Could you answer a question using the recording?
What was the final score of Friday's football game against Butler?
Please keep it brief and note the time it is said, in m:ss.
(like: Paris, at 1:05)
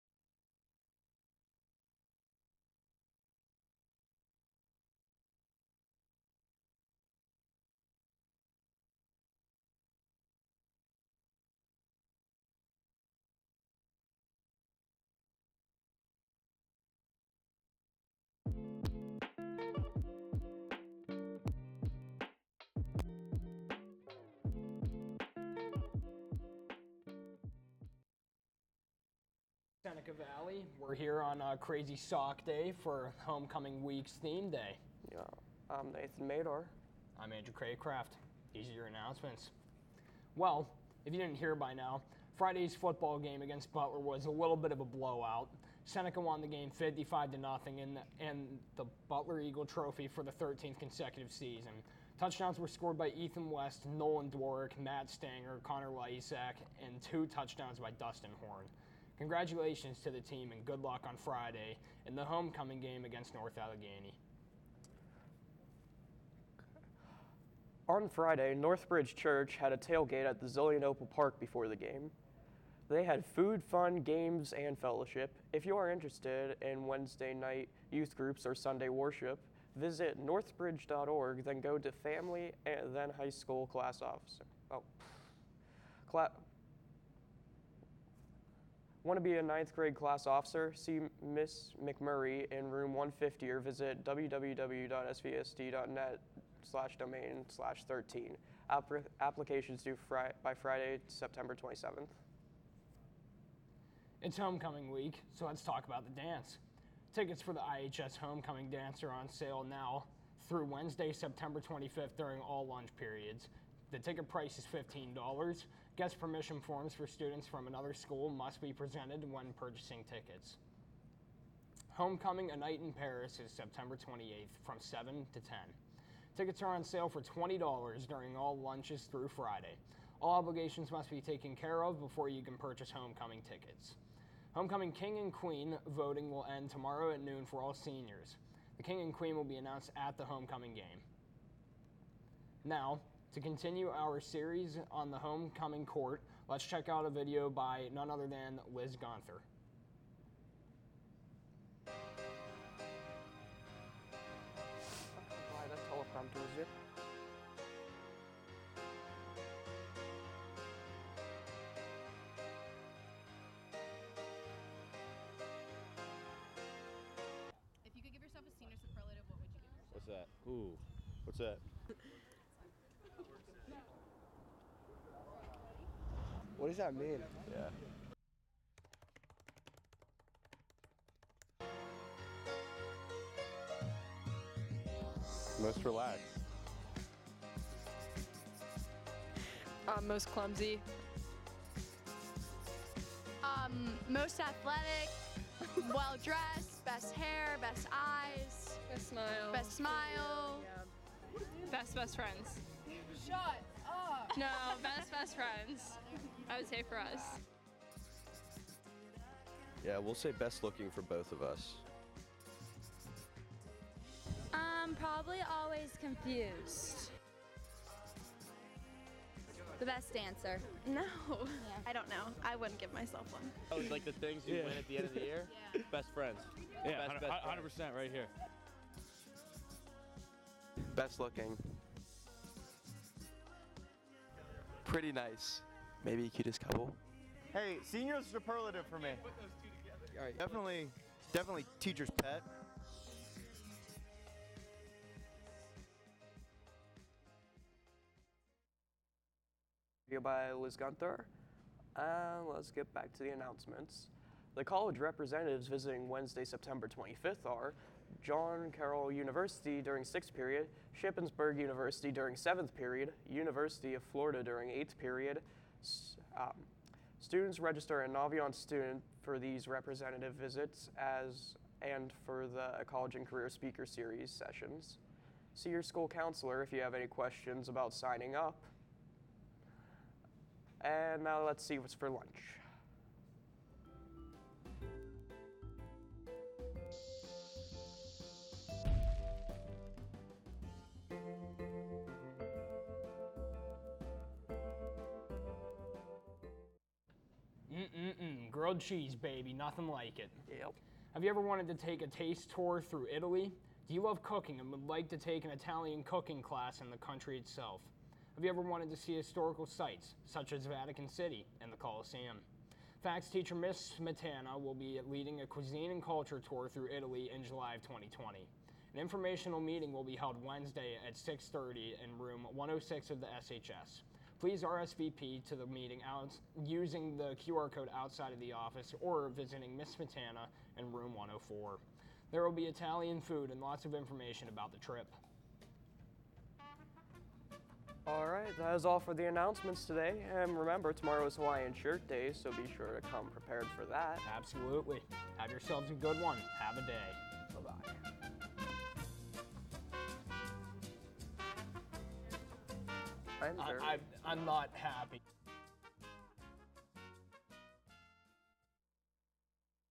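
55 to 0, at 0:46.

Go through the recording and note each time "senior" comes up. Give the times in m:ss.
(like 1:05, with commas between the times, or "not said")
2:17, 2:48, 3:57.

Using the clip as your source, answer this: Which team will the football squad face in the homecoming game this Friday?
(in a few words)
North Allegheny.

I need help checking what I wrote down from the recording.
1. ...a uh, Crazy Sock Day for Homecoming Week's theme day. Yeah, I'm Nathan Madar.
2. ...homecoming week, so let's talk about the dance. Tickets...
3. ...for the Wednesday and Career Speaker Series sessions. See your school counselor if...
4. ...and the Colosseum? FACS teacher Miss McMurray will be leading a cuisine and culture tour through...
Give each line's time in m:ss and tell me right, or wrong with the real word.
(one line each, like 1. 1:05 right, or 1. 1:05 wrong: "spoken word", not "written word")
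1. 0:31 right
2. 1:44 right
3. 4:32 wrong: "College", not "Wednesday"
4. 5:11 wrong: "Smetana", not "McMurray".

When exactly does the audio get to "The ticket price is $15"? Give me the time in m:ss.
1:53.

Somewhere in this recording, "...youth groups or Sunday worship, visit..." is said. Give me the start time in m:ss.
1:17.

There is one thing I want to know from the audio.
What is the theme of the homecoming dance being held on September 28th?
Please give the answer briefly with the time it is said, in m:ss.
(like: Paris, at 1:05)
A Night in Paris, at 2:02.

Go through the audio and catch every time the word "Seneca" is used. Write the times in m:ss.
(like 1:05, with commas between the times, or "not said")
0:29, 0:45.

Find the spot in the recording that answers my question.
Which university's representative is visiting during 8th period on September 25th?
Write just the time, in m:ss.
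4:23.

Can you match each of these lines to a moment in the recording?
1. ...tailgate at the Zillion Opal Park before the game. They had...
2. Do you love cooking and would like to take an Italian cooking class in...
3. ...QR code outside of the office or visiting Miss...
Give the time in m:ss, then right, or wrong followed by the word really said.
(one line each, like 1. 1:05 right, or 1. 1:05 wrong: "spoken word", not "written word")
1. 1:09 right
2. 5:03 right
3. 5:27 right.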